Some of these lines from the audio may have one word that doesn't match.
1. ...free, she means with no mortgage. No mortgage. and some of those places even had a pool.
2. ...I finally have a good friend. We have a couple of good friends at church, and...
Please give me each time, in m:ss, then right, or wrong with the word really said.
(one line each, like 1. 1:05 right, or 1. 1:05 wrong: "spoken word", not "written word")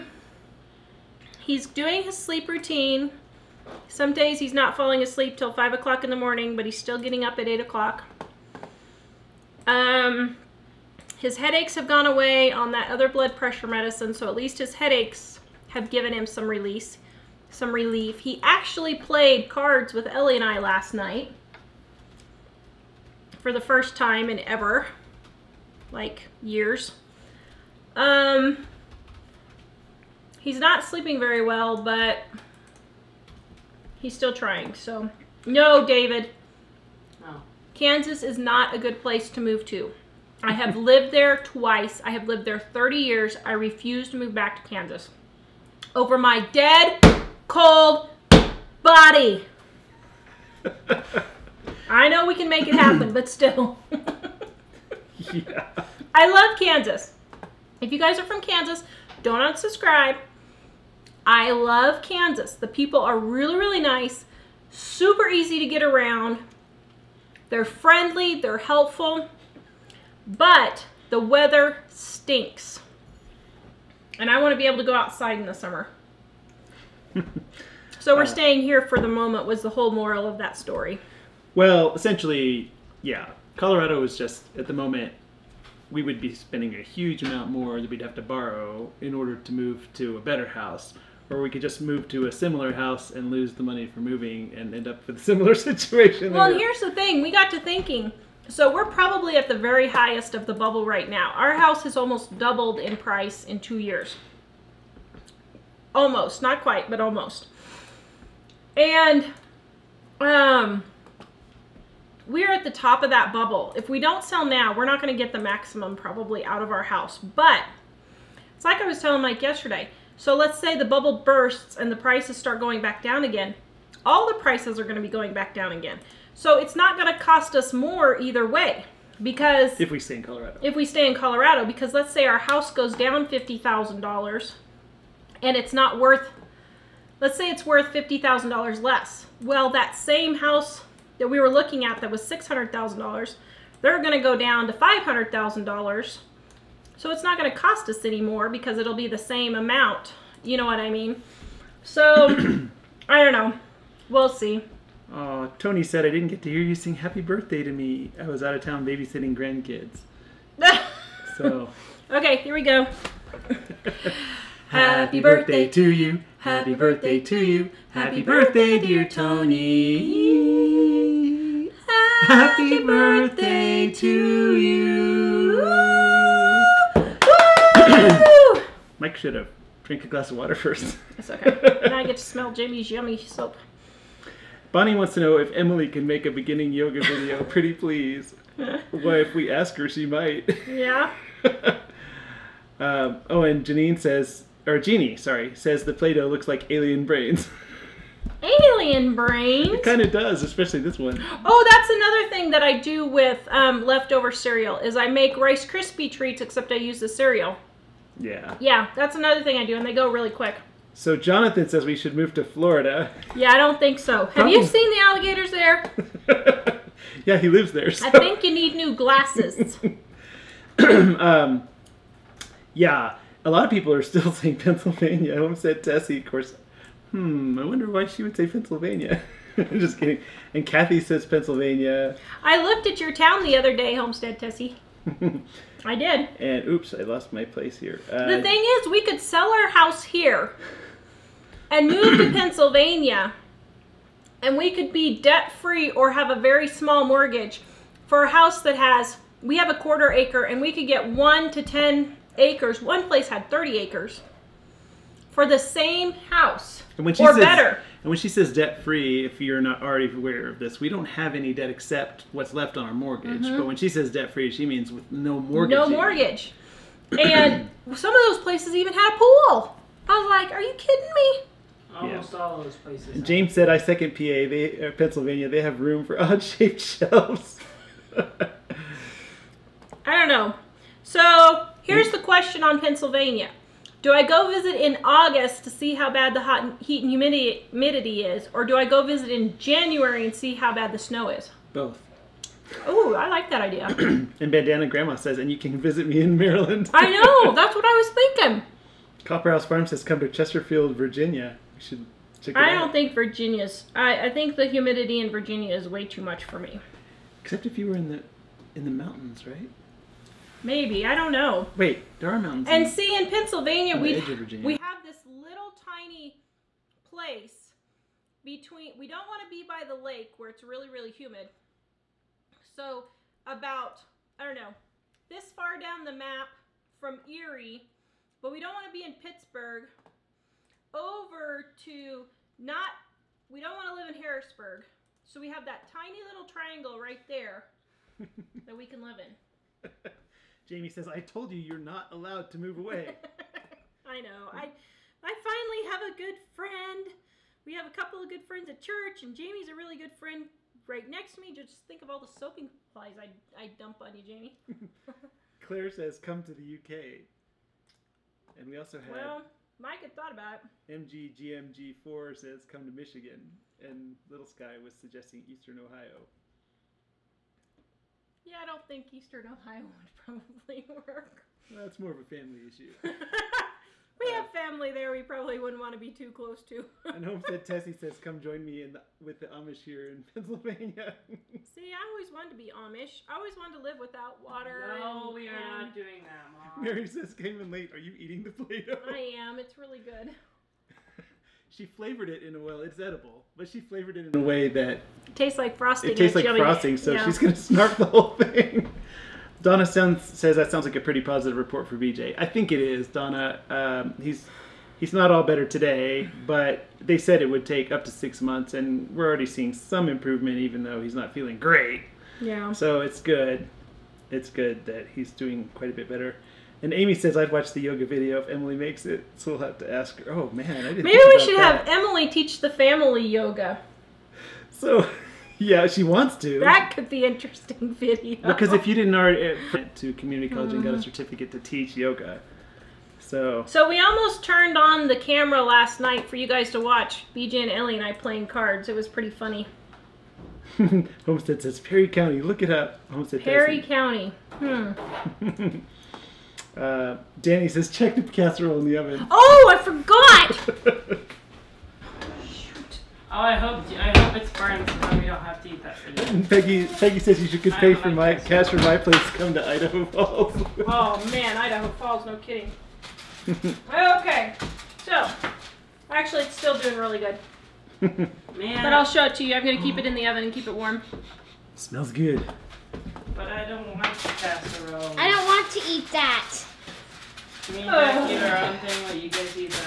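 1. 4:24 right
2. 5:45 right.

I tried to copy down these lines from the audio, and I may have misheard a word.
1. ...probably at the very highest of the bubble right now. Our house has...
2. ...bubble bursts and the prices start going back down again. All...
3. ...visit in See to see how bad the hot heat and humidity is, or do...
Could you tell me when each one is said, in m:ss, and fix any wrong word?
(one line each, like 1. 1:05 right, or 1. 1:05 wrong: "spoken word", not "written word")
1. 1:38 right
2. 2:00 right
3. 4:44 wrong: "August", not "See".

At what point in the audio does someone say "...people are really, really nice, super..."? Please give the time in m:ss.
1:02.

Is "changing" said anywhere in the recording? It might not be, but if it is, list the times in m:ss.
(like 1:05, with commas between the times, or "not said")
not said.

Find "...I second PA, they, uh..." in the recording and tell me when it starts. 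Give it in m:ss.
4:33.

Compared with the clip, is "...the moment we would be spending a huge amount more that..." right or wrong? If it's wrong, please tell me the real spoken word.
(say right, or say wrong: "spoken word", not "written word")
right.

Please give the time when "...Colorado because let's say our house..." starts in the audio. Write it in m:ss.
2:11.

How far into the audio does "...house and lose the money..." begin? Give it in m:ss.
1:32.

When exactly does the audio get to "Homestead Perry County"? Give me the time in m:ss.
7:23.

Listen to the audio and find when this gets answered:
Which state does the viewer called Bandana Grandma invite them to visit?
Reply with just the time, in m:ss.
4:56.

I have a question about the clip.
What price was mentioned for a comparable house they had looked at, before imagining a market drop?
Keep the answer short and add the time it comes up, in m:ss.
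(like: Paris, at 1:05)
$600,000, at 2:22.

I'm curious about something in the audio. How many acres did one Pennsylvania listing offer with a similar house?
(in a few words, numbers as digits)
30.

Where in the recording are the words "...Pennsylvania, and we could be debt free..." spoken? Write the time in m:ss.
4:02.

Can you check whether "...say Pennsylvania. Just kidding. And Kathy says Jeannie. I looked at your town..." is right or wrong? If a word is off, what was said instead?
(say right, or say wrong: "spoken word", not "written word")
wrong: "Pennsylvania", not "Jeannie".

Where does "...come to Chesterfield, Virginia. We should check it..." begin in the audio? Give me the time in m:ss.
5:00.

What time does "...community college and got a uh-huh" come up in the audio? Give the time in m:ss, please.
7:10.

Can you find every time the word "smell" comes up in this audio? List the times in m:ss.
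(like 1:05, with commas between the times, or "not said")
3:02, 7:51.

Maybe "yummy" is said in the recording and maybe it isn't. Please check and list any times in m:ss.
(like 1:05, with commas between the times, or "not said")
3:02, 6:36.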